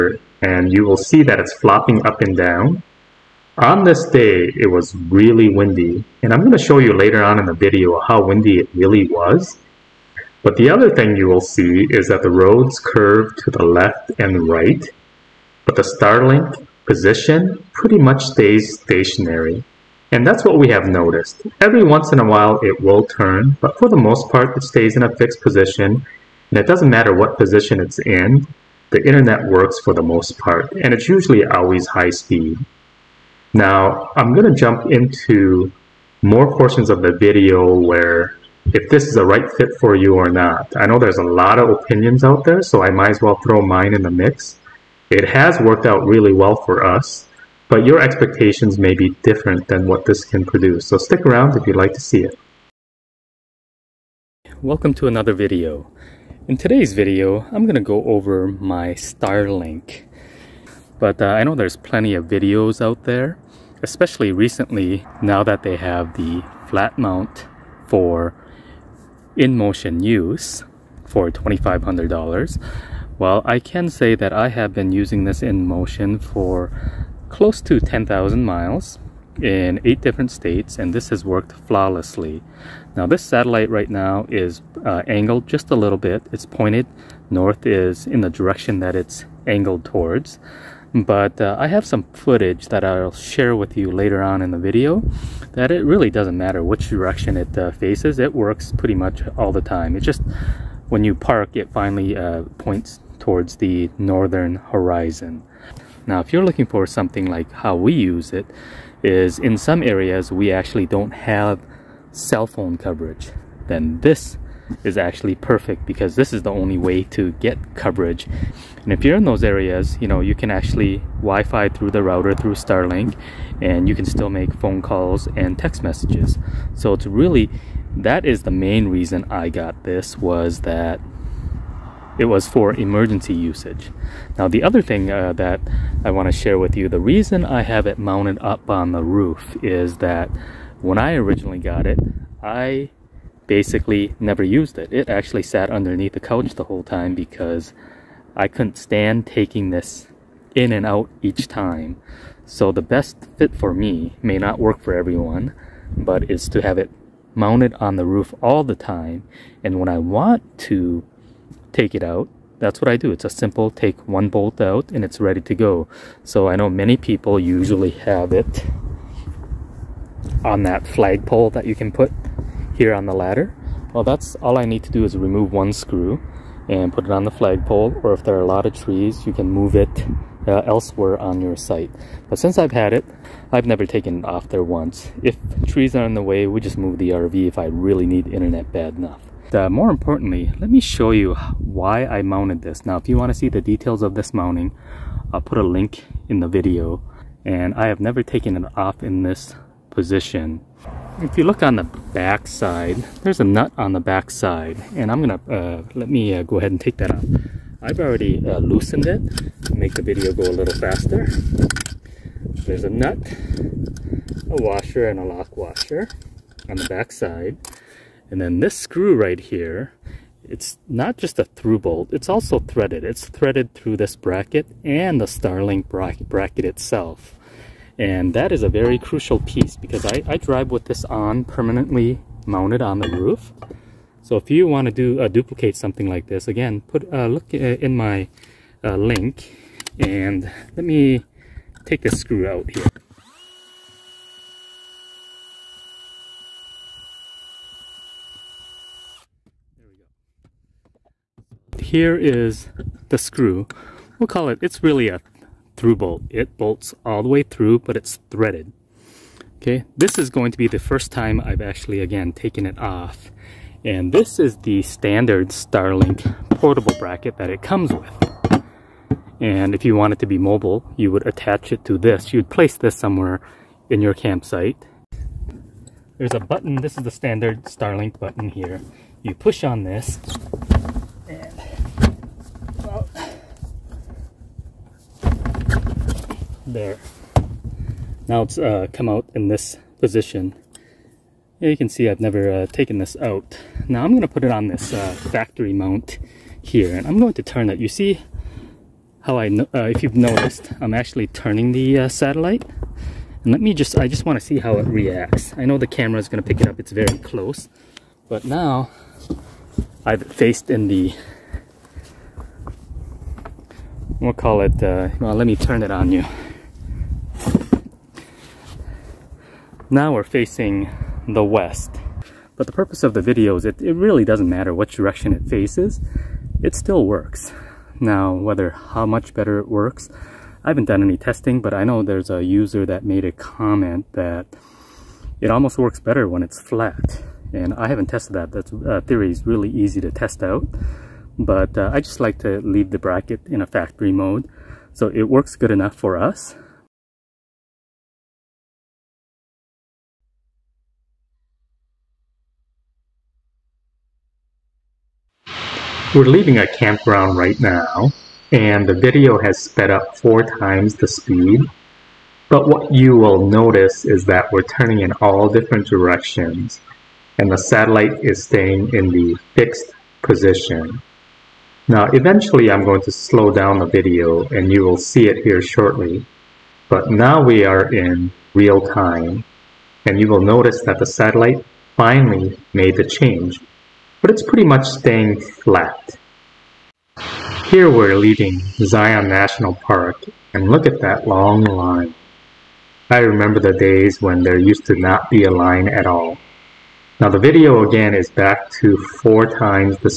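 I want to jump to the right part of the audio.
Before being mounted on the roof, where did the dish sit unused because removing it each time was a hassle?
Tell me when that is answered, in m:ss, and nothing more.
2:25.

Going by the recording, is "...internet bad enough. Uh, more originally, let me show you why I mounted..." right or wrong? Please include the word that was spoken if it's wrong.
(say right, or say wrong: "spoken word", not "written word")
wrong: "importantly", not "originally".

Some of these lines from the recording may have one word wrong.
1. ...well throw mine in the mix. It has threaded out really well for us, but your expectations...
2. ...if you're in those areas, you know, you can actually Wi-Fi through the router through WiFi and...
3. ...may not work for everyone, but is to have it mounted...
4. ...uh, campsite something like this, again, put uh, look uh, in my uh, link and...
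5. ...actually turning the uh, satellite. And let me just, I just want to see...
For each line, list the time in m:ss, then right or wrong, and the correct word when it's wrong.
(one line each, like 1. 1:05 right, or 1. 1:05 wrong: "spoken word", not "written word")
1. 0:43 wrong: "worked", not "threaded"
2. 1:58 wrong: "Starlink", not "WiFi"
3. 2:34 right
4. 3:55 wrong: "duplicate", not "campsite"
5. 5:00 right.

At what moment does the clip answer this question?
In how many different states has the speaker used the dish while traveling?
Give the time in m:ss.
1:19.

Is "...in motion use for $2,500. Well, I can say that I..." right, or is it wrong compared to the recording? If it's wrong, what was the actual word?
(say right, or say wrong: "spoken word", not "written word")
right.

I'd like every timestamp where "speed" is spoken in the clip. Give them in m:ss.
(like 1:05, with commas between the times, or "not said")
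0:32, 6:01.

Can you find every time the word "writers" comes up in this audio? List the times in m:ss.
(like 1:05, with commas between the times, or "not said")
not said.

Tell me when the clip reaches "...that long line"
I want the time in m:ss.
6:31.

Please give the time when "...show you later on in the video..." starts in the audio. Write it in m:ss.
0:06.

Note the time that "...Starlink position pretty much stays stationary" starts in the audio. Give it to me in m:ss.
0:15.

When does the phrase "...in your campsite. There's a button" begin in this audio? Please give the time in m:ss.
4:33.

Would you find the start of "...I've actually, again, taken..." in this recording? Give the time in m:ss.
4:21.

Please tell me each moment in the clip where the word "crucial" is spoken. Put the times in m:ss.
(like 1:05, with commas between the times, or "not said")
3:48.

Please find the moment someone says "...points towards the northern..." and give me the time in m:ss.
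1:42.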